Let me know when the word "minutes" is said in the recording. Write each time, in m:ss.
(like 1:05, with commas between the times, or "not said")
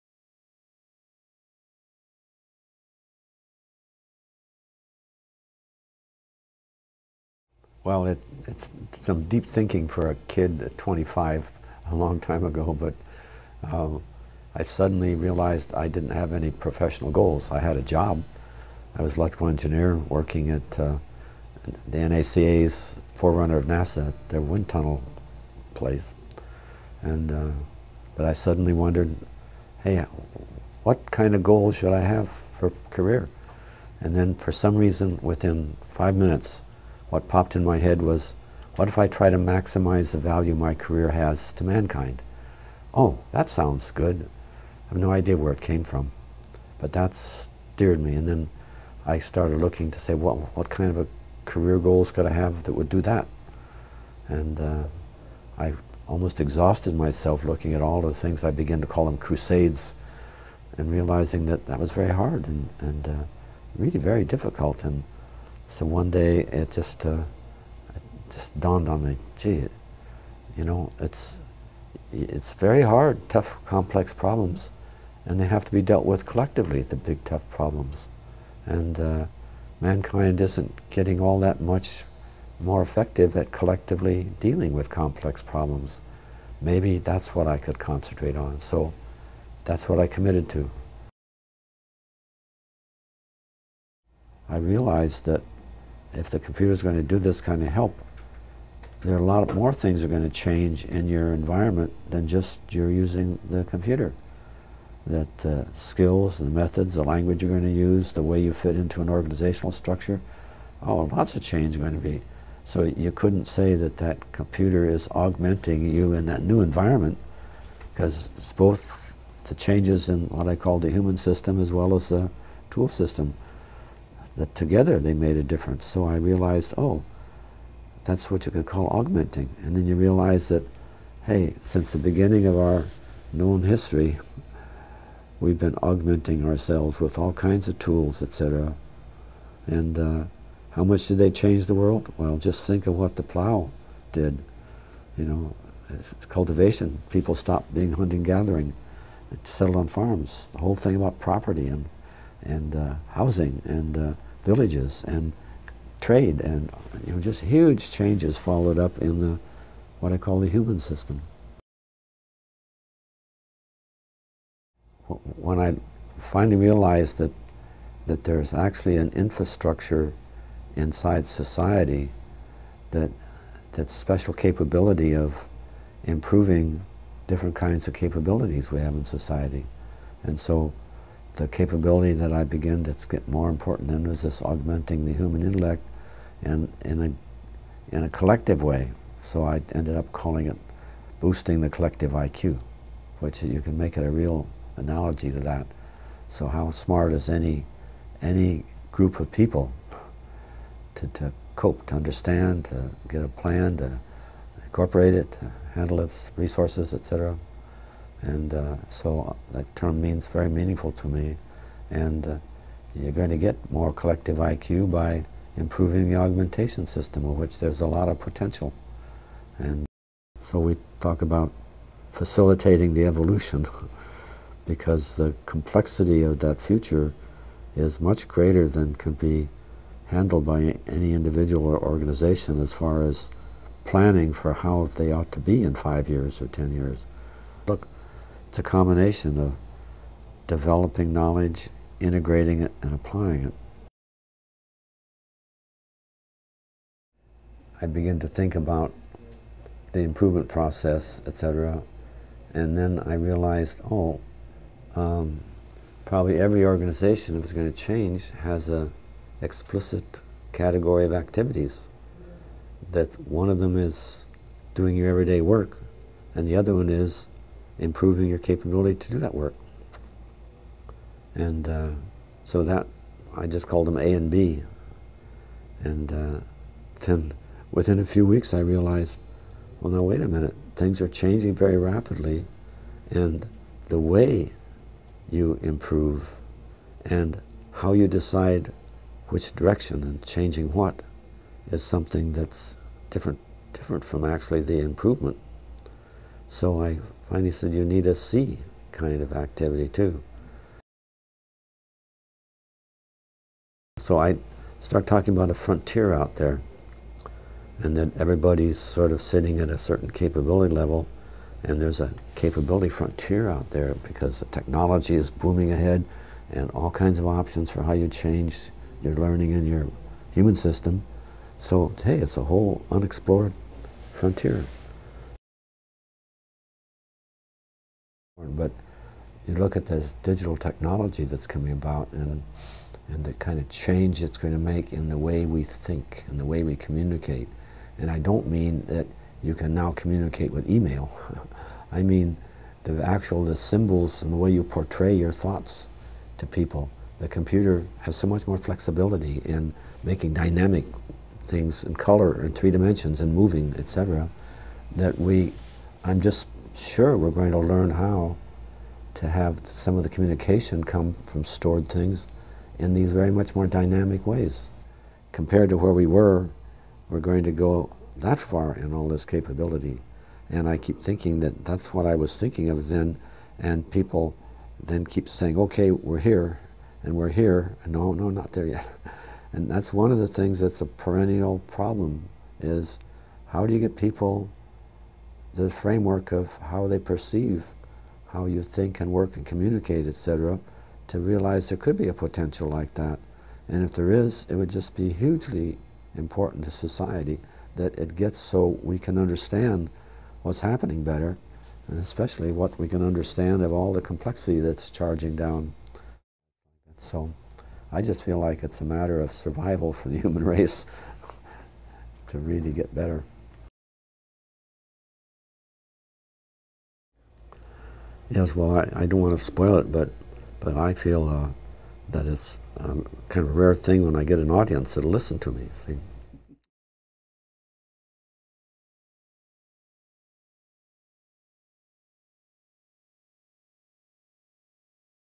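0:36, 4:40.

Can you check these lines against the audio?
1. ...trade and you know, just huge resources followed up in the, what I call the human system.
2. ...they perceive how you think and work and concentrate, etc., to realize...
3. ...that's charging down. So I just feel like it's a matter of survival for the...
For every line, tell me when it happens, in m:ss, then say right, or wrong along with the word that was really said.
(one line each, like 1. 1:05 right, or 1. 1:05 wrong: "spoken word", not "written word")
1. 2:35 wrong: "changes", not "resources"
2. 6:26 wrong: "communicate", not "concentrate"
3. 6:44 right.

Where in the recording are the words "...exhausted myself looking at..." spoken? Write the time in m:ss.
0:56.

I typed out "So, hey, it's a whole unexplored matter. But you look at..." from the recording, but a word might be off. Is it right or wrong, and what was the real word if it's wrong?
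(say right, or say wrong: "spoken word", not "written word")
wrong: "frontier", not "matter".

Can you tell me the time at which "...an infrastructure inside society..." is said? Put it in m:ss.
2:48.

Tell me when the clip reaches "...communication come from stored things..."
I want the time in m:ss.
6:00.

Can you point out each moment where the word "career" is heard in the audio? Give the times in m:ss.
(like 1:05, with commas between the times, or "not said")
0:32, 0:40, 0:51.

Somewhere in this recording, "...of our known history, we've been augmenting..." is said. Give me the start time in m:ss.
2:12.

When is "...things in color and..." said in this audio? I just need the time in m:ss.
5:51.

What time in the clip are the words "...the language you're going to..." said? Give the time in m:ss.
1:46.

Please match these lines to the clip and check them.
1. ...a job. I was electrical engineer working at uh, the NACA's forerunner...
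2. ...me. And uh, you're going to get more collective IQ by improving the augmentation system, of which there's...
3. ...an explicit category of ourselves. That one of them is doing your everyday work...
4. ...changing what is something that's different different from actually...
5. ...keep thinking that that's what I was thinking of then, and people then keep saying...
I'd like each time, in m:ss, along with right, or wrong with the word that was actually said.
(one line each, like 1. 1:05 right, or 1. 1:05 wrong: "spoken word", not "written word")
1. 0:17 right
2. 3:31 right
3. 4:18 wrong: "activities", not "ourselves"
4. 4:50 right
5. 6:10 right.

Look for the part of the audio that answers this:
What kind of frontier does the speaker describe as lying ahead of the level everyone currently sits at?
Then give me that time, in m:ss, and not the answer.
5:12.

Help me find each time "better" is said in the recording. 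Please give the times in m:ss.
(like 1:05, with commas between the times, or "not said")
6:41, 6:52.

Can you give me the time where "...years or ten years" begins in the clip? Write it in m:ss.
3:56.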